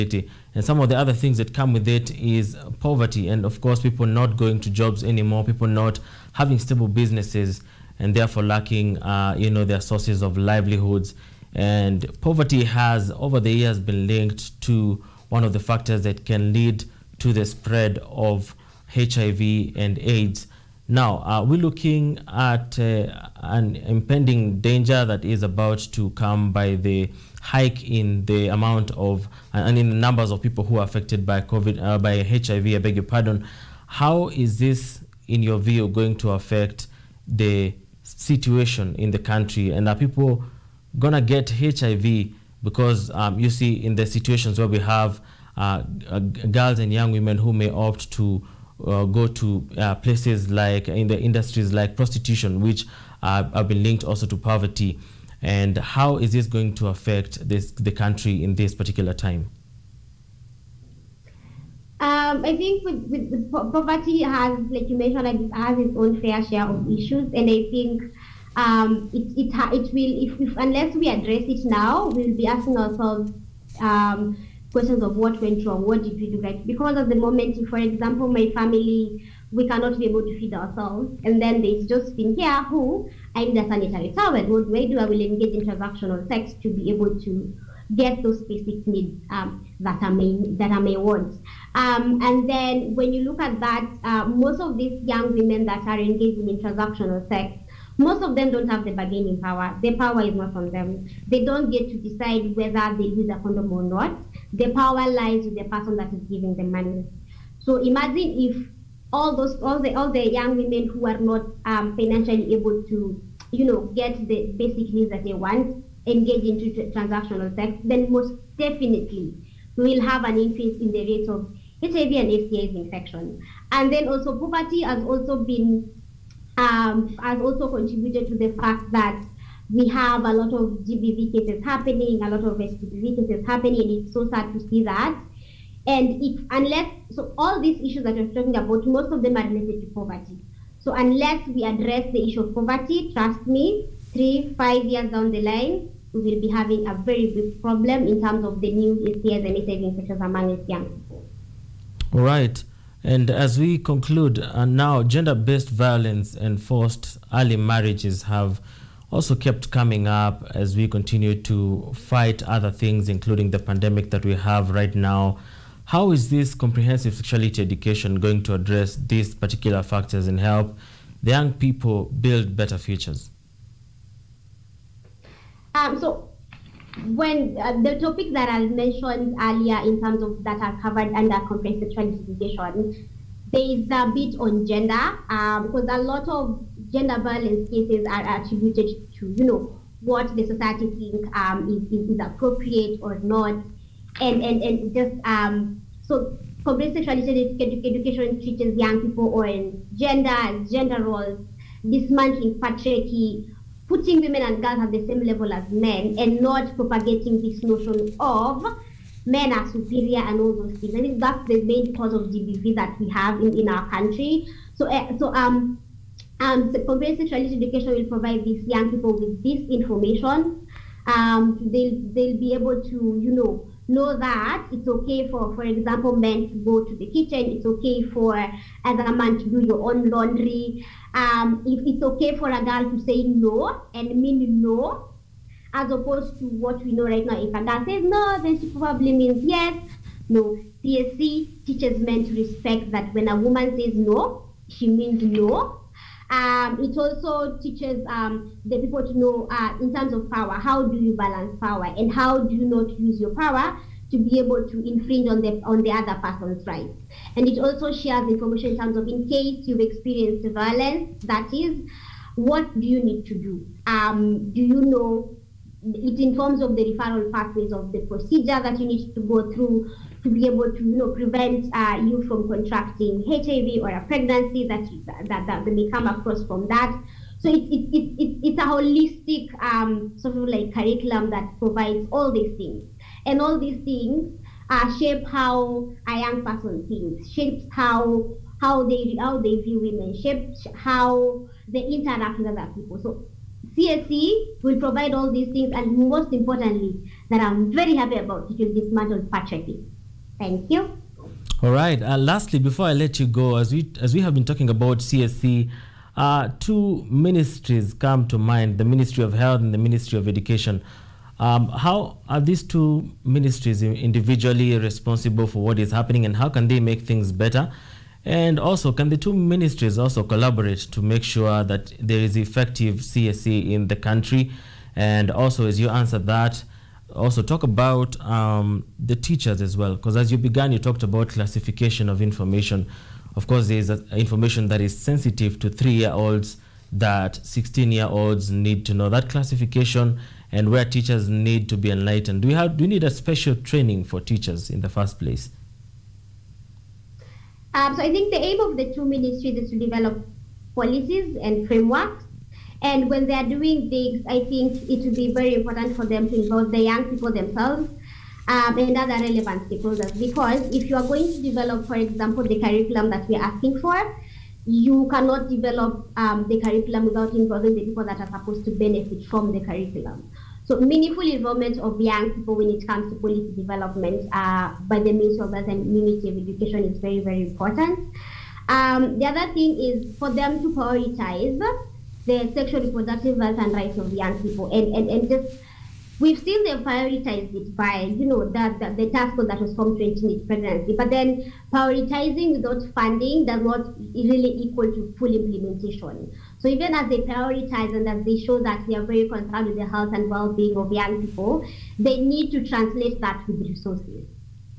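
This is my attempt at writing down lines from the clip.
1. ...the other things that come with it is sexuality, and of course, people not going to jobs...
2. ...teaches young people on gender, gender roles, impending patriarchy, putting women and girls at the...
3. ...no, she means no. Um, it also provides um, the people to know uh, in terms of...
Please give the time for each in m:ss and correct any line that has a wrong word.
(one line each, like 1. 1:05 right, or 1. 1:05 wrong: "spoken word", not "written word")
1. 0:00 wrong: "poverty", not "sexuality"
2. 3:18 wrong: "dismantling", not "impending"
3. 4:03 wrong: "teaches", not "provides".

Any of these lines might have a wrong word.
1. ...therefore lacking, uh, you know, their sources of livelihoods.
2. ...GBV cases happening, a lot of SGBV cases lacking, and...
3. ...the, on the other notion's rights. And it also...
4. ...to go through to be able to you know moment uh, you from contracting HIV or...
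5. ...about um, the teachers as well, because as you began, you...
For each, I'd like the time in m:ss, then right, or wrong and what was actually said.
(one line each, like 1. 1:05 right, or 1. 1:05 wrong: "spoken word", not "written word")
1. 0:08 right
2. 2:10 wrong: "happening", not "lacking"
3. 4:15 wrong: "person", not "notion"
4. 4:29 wrong: "prevent", not "moment"
5. 5:27 right.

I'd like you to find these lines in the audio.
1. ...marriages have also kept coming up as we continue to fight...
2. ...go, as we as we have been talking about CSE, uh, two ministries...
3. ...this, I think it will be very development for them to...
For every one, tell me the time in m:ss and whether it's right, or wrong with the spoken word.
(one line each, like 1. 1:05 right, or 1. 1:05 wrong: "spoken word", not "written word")
1. 2:37 right
2. 5:03 right
3. 5:53 wrong: "important", not "development".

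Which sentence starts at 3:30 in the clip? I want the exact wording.
I think that's the main cause of GBV that we have in, in our country.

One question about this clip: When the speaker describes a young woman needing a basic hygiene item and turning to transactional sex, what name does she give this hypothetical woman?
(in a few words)
Josephine.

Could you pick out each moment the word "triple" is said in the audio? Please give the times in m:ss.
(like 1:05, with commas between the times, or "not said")
not said.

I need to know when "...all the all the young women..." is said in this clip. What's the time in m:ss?
1:49.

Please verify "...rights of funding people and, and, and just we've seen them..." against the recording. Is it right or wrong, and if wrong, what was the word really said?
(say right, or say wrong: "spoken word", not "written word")
wrong: "young", not "funding".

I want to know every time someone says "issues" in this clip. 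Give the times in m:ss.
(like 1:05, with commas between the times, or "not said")
1:06, 2:17, 2:22.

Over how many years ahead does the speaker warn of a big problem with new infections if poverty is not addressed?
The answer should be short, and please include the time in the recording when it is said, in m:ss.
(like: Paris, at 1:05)
3 to 5 years, at 2:24.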